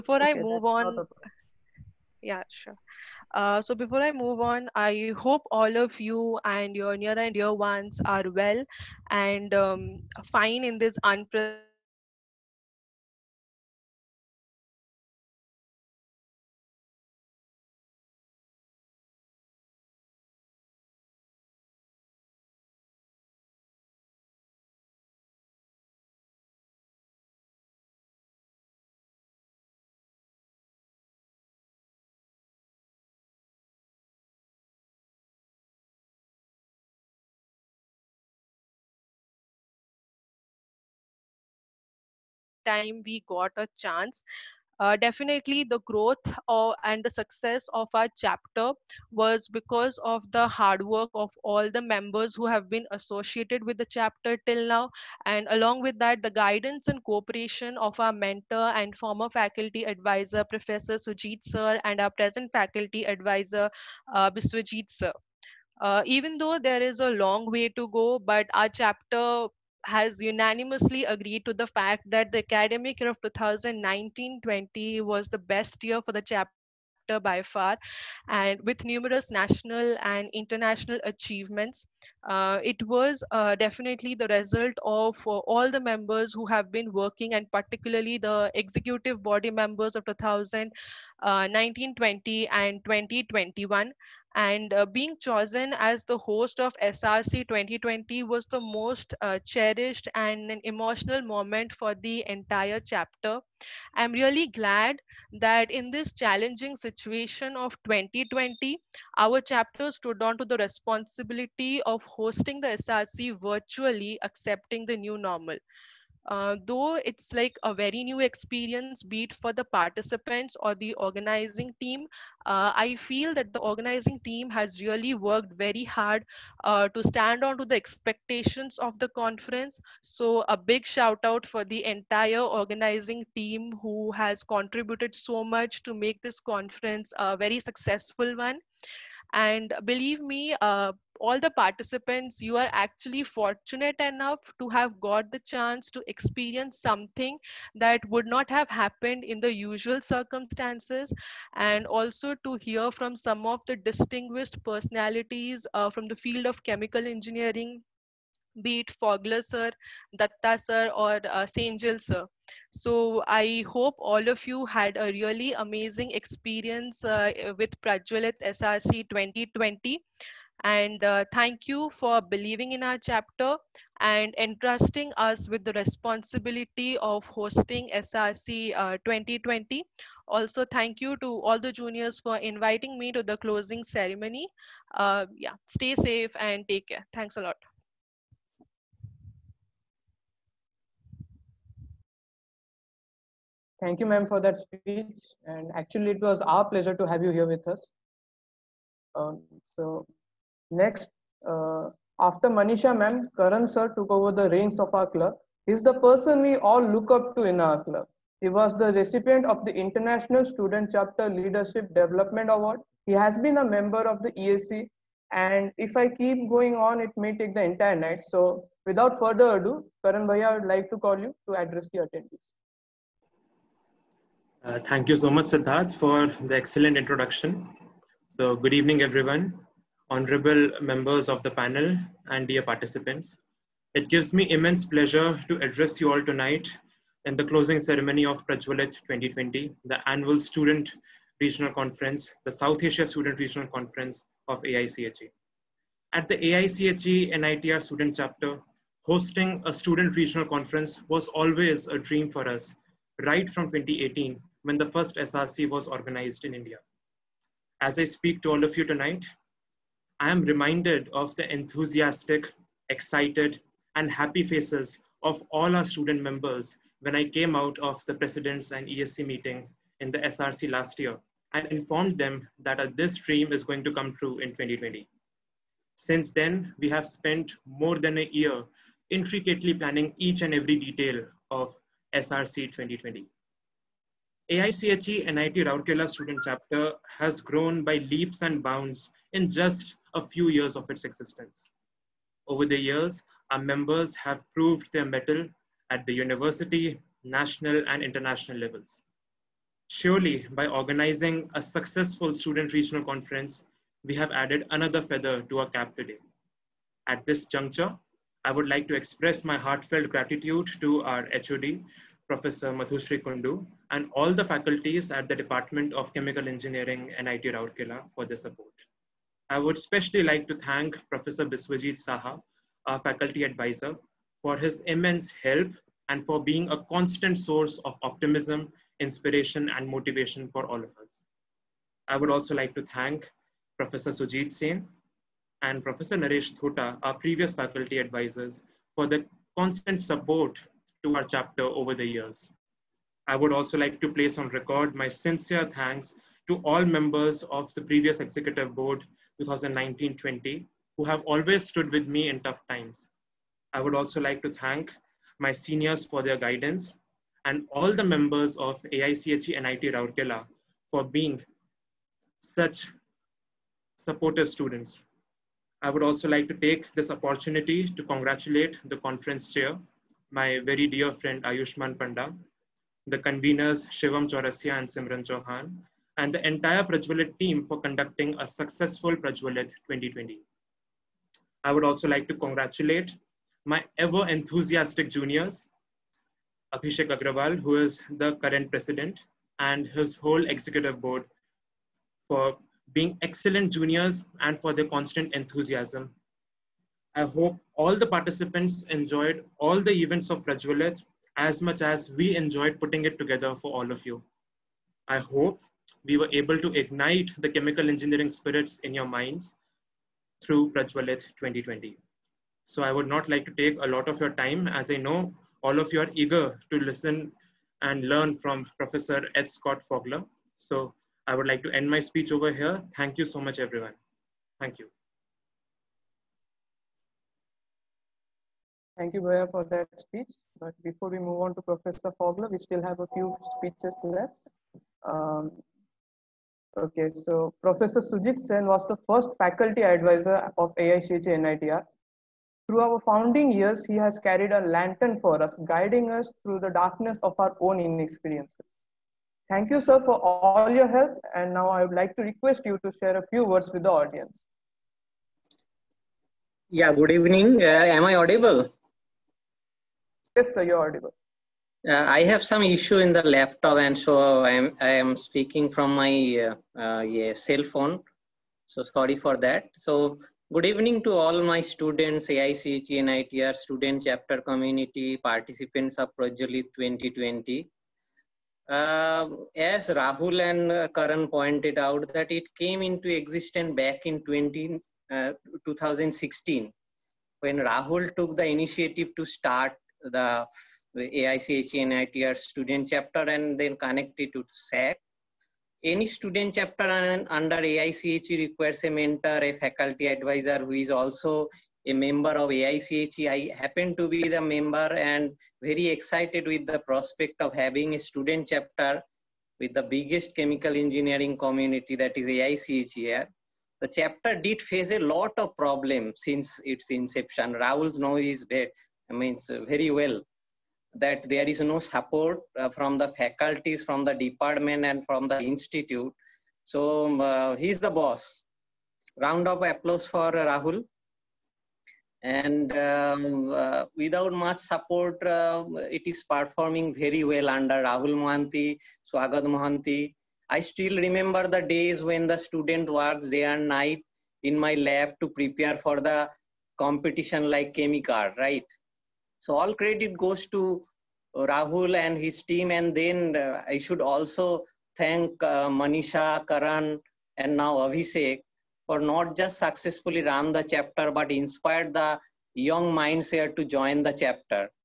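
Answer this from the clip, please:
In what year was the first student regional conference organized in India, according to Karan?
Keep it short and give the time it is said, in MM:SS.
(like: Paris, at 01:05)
2018, at 04:13.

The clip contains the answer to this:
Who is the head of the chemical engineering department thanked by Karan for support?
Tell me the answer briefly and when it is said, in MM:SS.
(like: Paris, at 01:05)
Madhusri Kundu, at 05:12.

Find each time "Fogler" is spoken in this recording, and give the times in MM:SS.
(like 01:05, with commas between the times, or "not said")
02:38, 06:59, 07:12.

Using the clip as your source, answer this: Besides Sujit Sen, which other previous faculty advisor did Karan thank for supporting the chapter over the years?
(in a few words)
Nareesh Thota.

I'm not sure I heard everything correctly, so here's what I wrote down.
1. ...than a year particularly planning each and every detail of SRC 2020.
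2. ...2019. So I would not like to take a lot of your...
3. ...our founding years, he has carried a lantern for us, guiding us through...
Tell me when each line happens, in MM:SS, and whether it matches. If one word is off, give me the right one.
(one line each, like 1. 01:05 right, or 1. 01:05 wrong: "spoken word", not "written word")
1. 04:37 wrong: "intricately", not "particularly"
2. 06:51 wrong: "2020", not "2019"
3. 07:22 right.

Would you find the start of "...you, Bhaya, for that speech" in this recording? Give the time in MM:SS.
07:09.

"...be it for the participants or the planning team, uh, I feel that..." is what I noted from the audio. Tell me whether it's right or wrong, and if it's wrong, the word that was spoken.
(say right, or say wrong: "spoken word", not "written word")
wrong: "organizing", not "planning".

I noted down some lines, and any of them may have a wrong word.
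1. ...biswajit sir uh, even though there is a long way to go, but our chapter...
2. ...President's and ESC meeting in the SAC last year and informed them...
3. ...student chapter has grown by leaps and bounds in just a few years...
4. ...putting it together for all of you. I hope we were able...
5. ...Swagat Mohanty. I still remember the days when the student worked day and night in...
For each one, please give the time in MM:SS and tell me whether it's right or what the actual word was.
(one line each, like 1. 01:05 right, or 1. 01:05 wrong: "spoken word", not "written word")
1. 01:04 right
2. 04:28 wrong: "SRC", not "SAC"
3. 04:46 right
4. 06:42 right
5. 08:59 right.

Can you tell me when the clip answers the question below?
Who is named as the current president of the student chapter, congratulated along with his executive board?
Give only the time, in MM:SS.
06:26.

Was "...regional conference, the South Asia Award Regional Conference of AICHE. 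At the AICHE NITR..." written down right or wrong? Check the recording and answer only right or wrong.
wrong.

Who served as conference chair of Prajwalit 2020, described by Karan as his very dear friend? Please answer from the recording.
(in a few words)
Ayushman Panda.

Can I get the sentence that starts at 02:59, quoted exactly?
Uh, also, thank you to all the juniors for inviting me to the closing ceremony.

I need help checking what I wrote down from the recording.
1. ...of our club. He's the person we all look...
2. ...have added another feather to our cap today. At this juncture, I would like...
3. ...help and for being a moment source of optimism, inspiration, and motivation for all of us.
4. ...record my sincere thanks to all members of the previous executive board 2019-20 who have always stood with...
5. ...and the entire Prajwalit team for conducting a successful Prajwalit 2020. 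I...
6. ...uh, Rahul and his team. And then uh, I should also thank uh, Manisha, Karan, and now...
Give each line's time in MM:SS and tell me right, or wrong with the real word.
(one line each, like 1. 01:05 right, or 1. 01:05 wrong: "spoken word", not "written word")
1. 03:24 right
2. 05:04 right
3. 05:25 wrong: "constant", not "moment"
4. 05:44 right
5. 06:16 right
6. 09:11 right.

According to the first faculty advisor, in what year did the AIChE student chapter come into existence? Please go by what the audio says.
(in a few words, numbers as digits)
2016.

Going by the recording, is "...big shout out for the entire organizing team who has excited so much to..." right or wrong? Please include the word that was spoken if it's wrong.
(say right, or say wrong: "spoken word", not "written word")
wrong: "contributed", not "excited".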